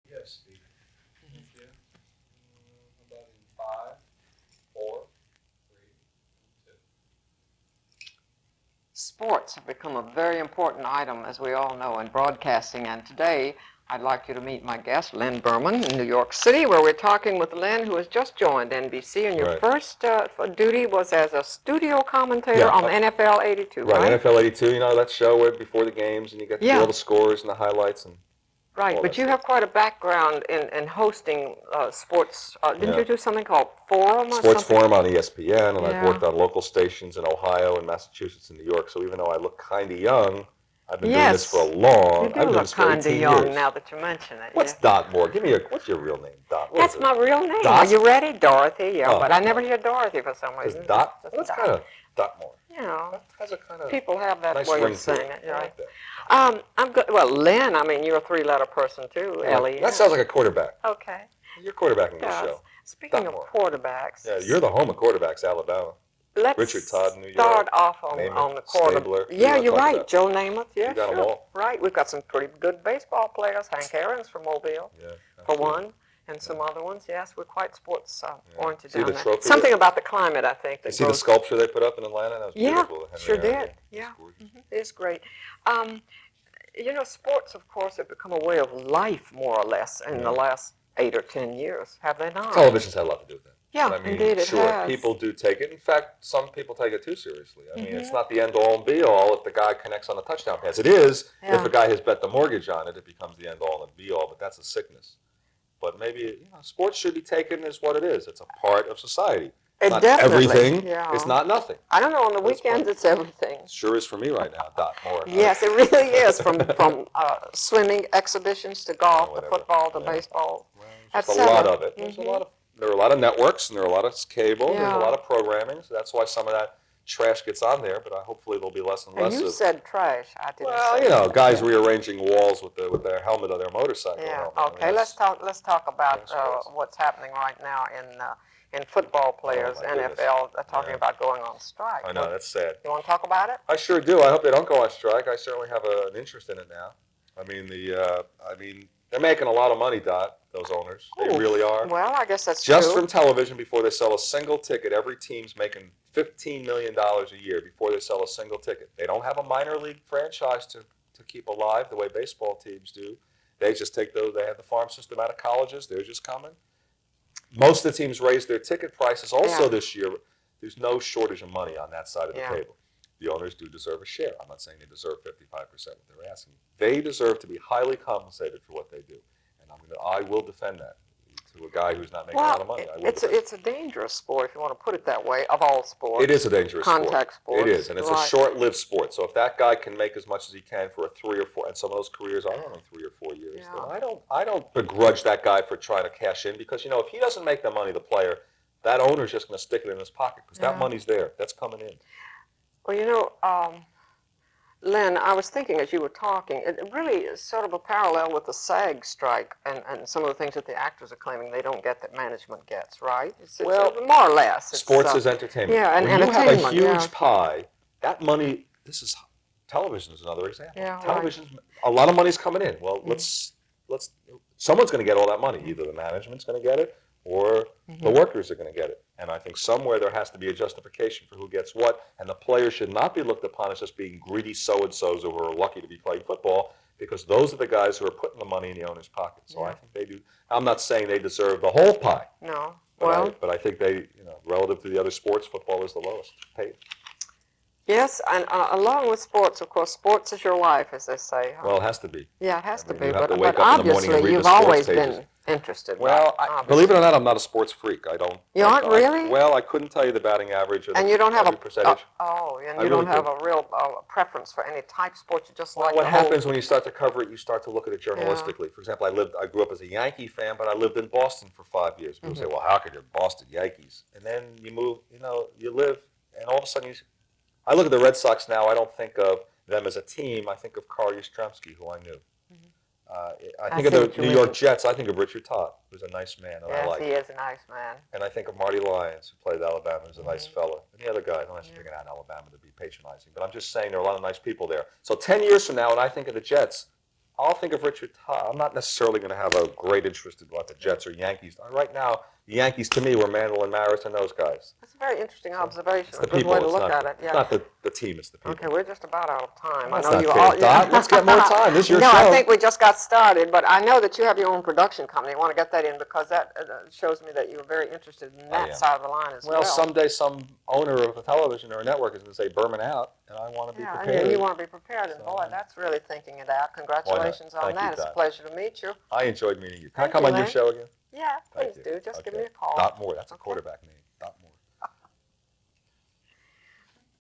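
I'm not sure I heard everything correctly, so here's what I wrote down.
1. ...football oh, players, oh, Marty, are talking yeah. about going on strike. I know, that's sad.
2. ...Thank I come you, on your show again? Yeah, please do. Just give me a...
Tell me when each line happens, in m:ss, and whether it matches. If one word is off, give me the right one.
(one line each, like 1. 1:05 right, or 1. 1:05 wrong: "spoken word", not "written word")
1. 2:18 wrong: "NFL", not "Marty"
2. 5:30 right.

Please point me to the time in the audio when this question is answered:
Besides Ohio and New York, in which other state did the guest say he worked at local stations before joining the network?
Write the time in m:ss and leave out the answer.
0:37.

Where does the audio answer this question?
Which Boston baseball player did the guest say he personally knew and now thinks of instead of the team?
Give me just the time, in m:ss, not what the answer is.
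4:40.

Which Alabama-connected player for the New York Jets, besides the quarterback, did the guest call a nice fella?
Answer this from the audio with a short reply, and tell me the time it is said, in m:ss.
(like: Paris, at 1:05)
Marty Lyons, at 4:48.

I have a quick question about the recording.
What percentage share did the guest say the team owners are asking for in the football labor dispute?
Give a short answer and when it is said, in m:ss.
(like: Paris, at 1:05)
55%, at 2:55.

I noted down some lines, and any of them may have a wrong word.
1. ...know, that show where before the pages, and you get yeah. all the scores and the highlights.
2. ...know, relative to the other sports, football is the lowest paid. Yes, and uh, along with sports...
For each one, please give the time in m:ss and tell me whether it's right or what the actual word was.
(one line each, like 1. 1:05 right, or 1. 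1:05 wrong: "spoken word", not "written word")
1. 0:24 wrong: "games", not "pages"
2. 4:04 right.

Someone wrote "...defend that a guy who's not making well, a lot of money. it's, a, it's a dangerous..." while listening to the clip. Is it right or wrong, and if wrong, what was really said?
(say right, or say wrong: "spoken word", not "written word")
right.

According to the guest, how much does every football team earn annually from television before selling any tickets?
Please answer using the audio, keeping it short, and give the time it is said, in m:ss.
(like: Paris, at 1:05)
$15 million, at 2:36.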